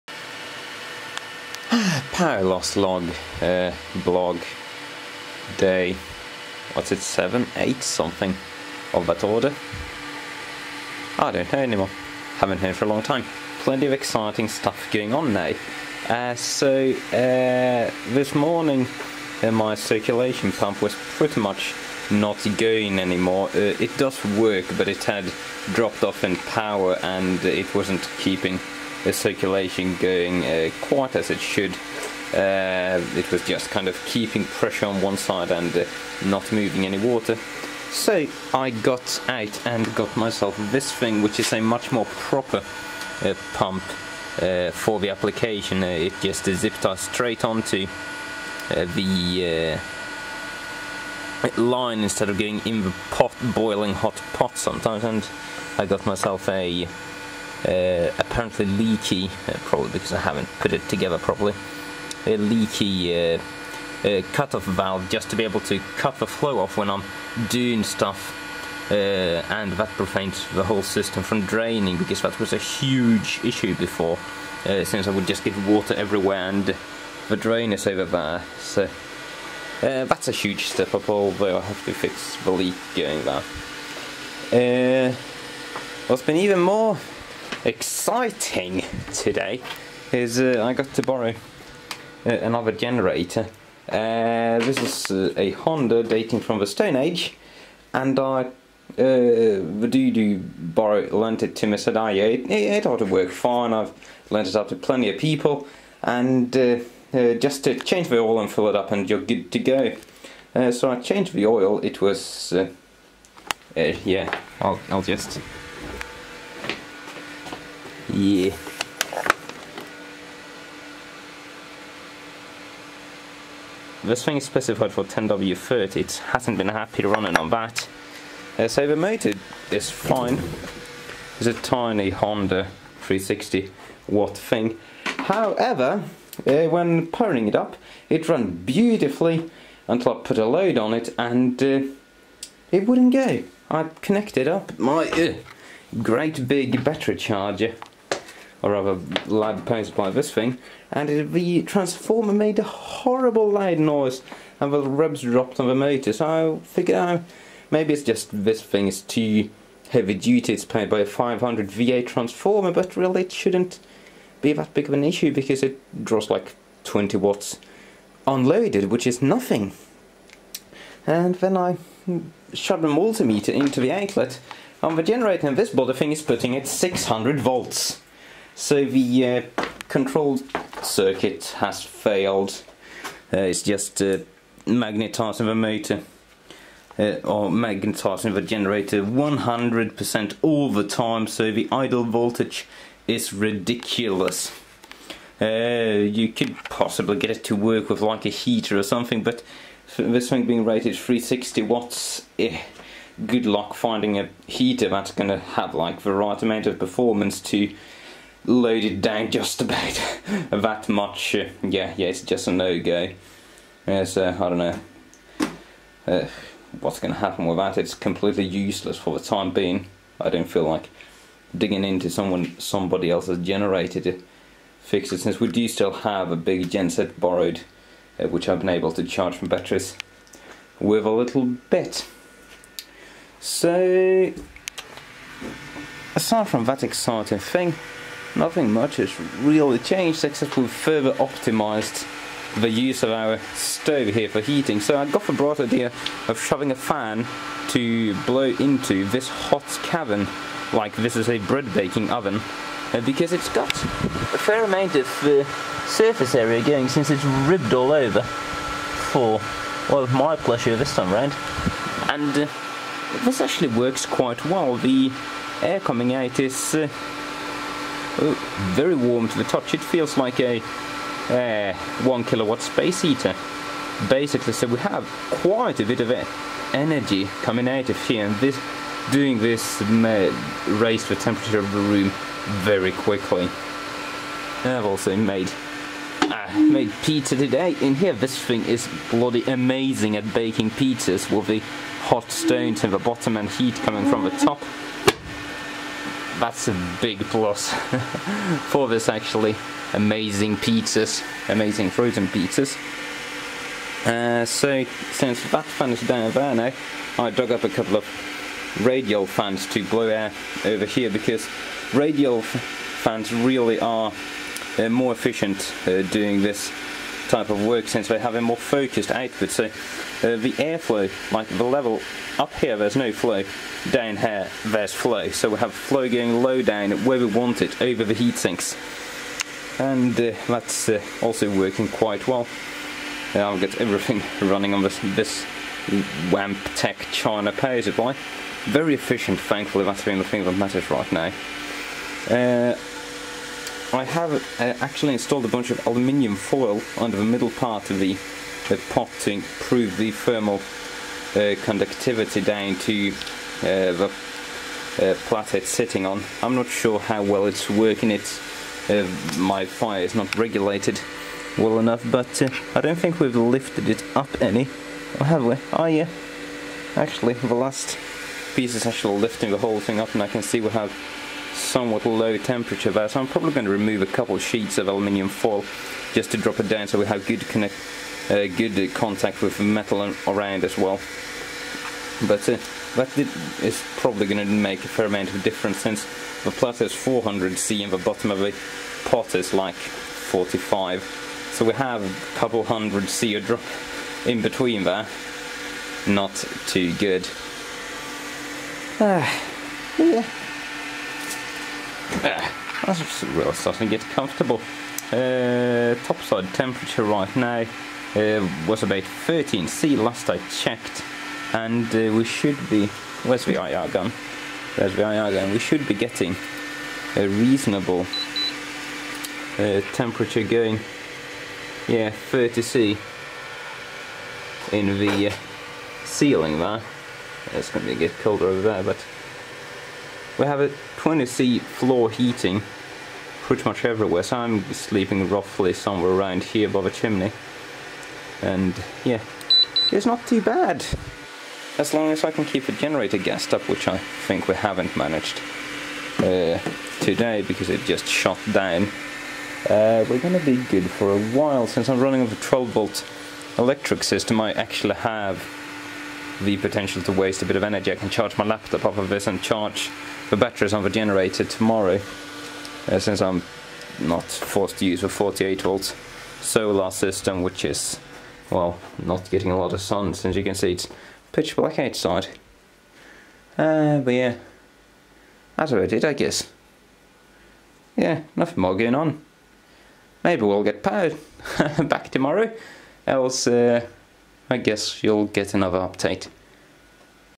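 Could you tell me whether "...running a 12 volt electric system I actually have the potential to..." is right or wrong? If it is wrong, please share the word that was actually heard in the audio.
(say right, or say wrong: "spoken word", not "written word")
right.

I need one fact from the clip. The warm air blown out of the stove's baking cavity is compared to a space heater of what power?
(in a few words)
1 kilowatt.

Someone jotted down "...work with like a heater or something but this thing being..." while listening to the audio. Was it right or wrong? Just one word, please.
right.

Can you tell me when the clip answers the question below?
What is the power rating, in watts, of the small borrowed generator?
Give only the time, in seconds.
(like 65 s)
132 s.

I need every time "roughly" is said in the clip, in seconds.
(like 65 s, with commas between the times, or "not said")
435 s.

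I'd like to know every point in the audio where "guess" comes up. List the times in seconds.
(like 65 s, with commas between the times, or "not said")
476 s, 484 s.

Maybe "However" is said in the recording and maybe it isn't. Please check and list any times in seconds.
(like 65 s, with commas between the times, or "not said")
135 s.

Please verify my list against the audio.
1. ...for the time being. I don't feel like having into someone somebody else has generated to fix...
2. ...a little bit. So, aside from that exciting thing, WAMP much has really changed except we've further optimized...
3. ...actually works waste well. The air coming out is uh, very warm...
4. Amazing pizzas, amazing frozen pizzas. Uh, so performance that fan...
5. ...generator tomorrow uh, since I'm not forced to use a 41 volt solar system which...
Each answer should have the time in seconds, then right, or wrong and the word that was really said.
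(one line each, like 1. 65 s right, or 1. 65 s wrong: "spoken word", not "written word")
1. 218 s wrong: "digging", not "having"
2. 231 s wrong: "Nothing", not "WAMP"
3. 263 s wrong: "quite", not "waste"
4. 299 s wrong: "since", not "performance"
5. 460 s wrong: "48", not "41".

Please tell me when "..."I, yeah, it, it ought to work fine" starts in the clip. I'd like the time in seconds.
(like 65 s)
101 s.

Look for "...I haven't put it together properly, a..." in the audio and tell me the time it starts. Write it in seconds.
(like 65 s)
60 s.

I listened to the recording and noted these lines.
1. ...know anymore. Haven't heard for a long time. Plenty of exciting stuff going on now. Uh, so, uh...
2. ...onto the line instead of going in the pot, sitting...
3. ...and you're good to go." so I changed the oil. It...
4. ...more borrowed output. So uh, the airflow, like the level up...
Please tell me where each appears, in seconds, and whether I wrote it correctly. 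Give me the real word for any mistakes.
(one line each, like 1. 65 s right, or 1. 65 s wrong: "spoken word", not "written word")
1. 11 s right
2. 47 s wrong: "boiling", not "sitting"
3. 108 s right
4. 318 s wrong: "focused", not "borrowed".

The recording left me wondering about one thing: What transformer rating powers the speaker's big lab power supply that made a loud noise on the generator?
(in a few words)
500 VA.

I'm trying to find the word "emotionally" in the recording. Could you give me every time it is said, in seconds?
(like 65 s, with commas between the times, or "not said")
not said.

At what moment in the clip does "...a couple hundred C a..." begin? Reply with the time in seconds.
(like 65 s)
392 s.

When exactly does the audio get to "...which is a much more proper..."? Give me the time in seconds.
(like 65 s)
41 s.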